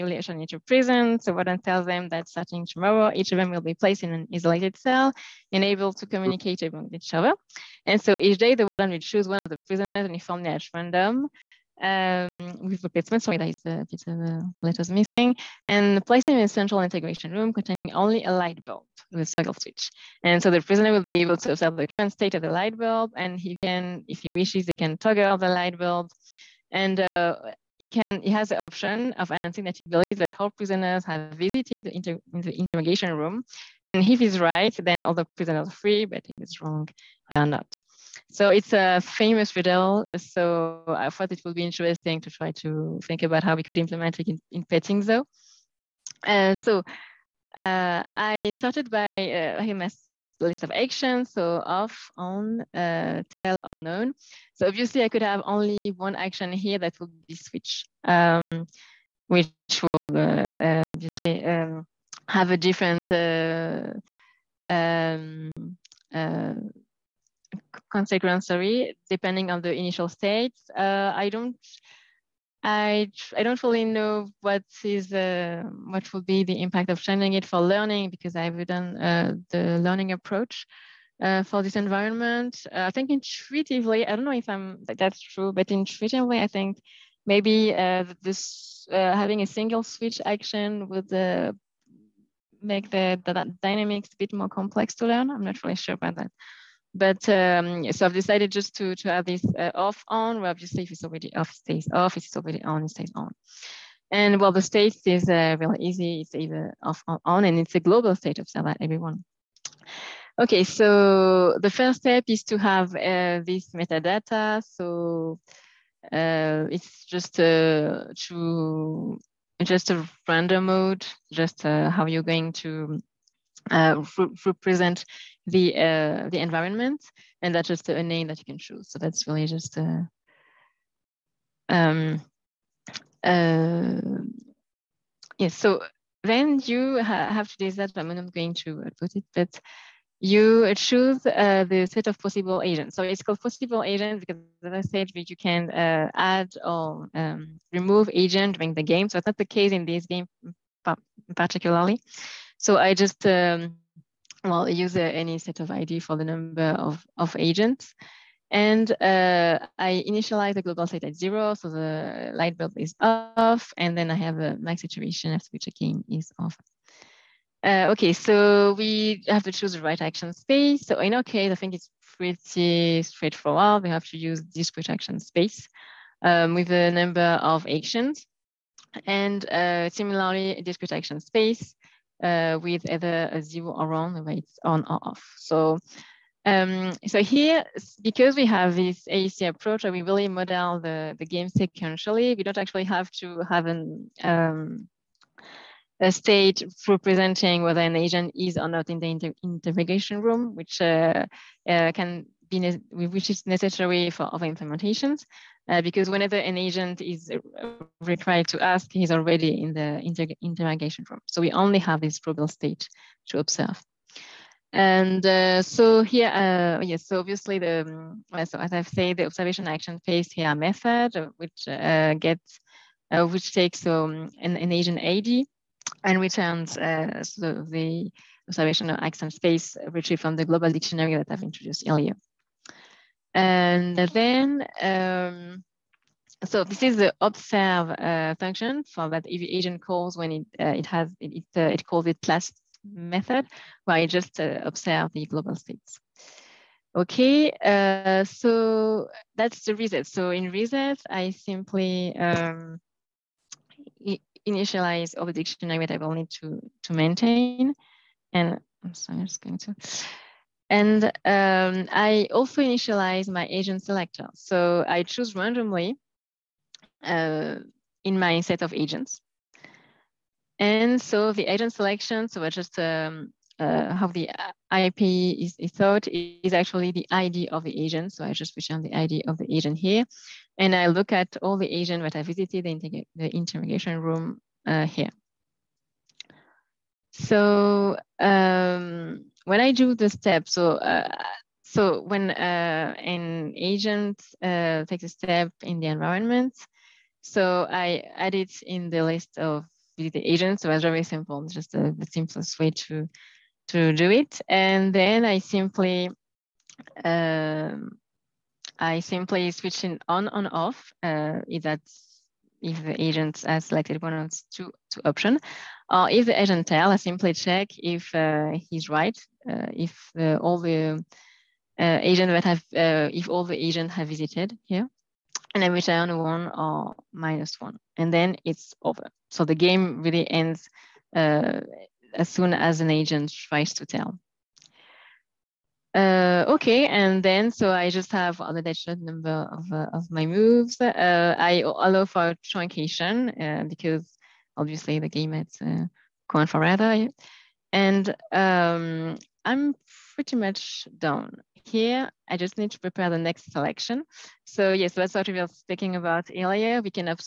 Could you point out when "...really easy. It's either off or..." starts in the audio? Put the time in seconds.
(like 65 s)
105 s.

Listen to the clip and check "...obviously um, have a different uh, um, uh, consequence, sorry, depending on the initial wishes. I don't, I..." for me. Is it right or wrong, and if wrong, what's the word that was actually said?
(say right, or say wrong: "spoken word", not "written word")
wrong: "states", not "wishes".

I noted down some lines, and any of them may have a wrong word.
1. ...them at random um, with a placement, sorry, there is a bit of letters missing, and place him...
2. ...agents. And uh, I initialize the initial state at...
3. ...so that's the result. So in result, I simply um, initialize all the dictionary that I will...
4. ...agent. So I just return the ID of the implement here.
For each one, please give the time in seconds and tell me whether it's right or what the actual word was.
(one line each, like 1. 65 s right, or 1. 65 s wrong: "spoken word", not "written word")
1. 10 s right
2. 157 s wrong: "global", not "initial"
3. 248 s right
4. 277 s wrong: "agent", not "implement".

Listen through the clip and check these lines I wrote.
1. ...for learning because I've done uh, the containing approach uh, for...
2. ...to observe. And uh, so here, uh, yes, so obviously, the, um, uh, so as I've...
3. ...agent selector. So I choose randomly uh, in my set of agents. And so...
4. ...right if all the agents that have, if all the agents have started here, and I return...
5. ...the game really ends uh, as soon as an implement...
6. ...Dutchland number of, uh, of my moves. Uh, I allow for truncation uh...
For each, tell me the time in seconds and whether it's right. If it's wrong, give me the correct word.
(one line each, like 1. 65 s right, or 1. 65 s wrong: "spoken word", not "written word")
1. 77 s wrong: "learning", not "containing"
2. 213 s right
3. 263 s right
4. 318 s wrong: "visited", not "started"
5. 329 s wrong: "agent", not "implement"
6. 338 s right.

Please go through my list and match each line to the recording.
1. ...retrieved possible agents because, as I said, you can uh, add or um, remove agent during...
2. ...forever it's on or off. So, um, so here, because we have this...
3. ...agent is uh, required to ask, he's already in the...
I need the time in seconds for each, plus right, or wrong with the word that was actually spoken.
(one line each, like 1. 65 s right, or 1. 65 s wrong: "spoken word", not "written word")
1. 143 s wrong: "called", not "retrieved"
2. 184 s wrong: "whether", not "forever"
3. 206 s right.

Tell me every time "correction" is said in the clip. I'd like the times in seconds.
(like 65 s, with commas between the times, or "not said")
not said.